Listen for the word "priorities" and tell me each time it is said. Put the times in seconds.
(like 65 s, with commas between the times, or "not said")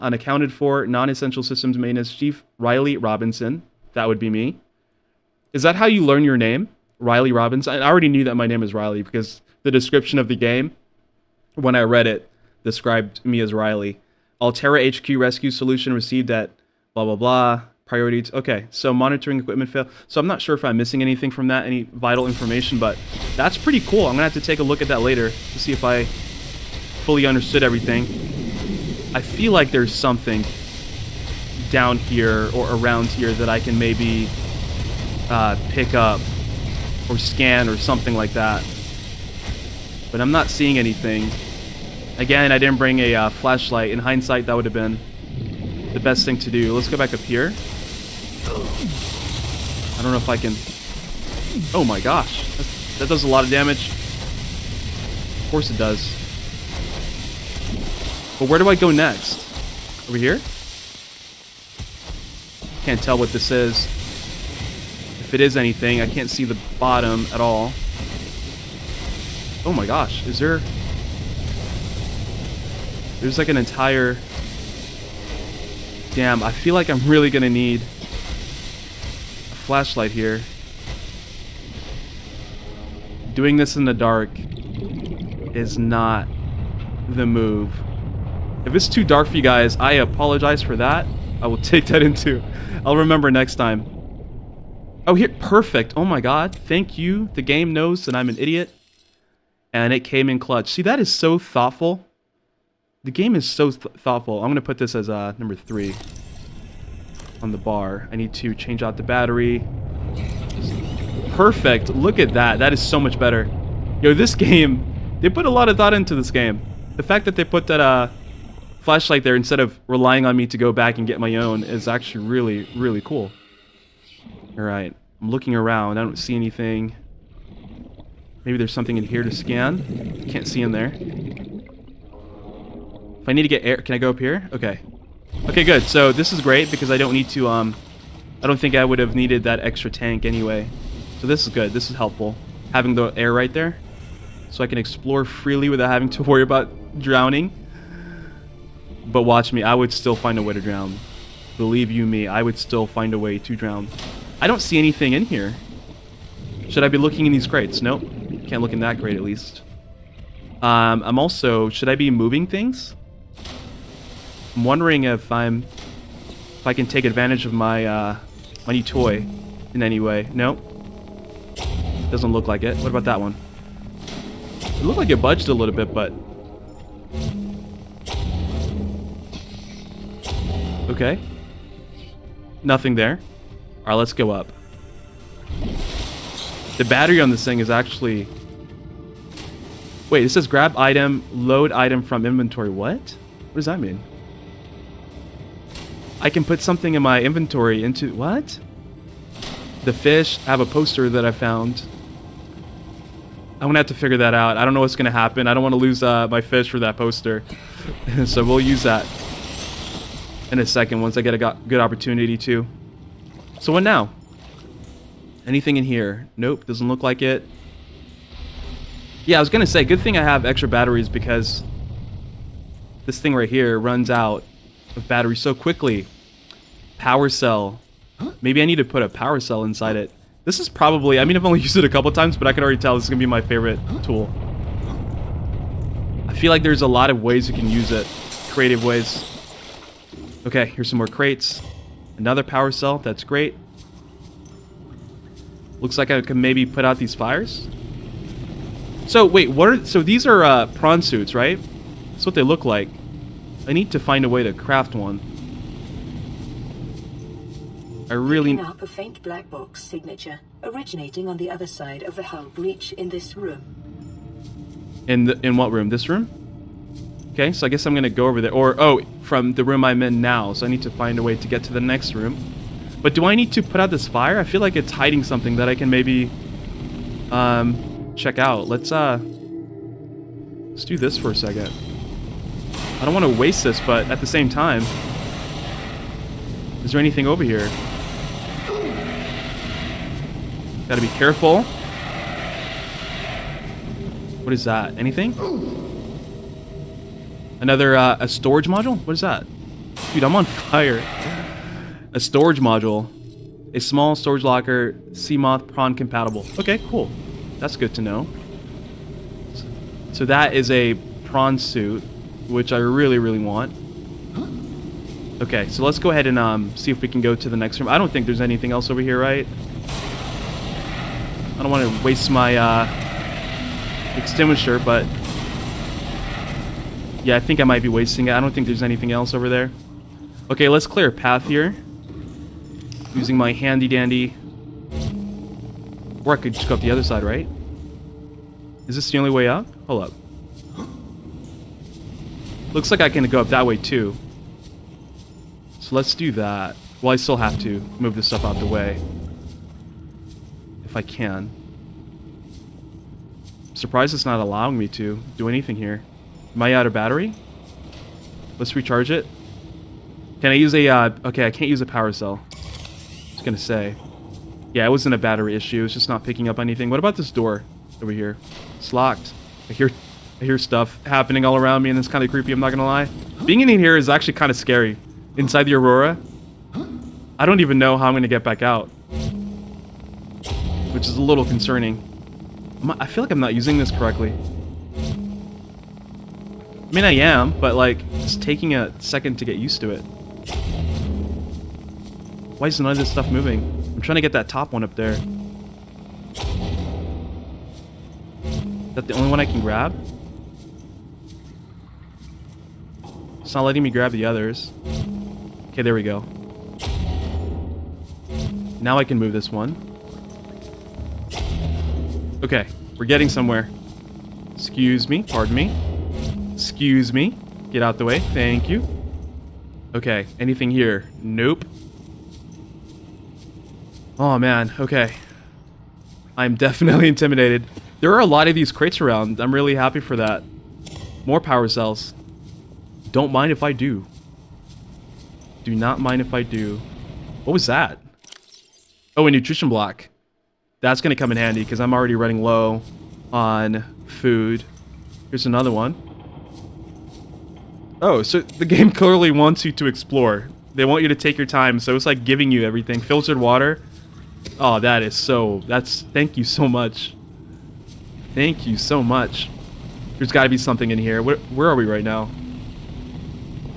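17 s.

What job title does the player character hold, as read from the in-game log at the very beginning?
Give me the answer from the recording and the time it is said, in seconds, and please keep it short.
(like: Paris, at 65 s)
Non-essential systems maintenance chief, at 0 s.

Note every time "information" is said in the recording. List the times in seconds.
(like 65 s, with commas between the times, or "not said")
22 s.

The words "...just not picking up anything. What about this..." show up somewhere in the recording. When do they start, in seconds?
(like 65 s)
365 s.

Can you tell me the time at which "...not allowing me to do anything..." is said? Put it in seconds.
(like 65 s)
354 s.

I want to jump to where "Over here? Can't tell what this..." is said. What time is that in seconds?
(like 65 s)
60 s.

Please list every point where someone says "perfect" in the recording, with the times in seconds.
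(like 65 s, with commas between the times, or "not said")
95 s, 111 s.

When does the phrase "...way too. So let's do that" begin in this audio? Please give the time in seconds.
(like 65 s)
343 s.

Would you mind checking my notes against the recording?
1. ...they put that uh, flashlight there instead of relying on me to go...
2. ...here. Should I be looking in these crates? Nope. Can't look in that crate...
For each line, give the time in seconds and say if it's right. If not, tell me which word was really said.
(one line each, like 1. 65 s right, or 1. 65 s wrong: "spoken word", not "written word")
1. 117 s right
2. 155 s right.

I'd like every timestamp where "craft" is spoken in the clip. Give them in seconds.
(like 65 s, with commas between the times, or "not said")
254 s.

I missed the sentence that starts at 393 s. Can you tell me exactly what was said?
I'm trying to get that top one up there.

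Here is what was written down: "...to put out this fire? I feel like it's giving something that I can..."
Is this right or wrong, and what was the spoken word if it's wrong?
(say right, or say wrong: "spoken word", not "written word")
wrong: "hiding", not "giving".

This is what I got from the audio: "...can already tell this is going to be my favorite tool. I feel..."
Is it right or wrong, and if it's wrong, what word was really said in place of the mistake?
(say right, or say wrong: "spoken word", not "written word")
right.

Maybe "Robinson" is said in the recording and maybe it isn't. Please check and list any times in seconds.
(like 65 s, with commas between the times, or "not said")
3 s, 7 s.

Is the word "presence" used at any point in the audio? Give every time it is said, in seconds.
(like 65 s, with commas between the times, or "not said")
not said.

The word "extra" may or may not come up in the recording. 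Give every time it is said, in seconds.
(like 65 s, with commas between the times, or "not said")
139 s, 220 s.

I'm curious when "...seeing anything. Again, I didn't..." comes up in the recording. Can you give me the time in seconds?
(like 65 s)
40 s.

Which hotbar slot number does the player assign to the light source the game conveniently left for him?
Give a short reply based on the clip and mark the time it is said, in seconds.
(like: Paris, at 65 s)
3, at 105 s.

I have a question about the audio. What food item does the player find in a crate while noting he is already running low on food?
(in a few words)
Nutrition block.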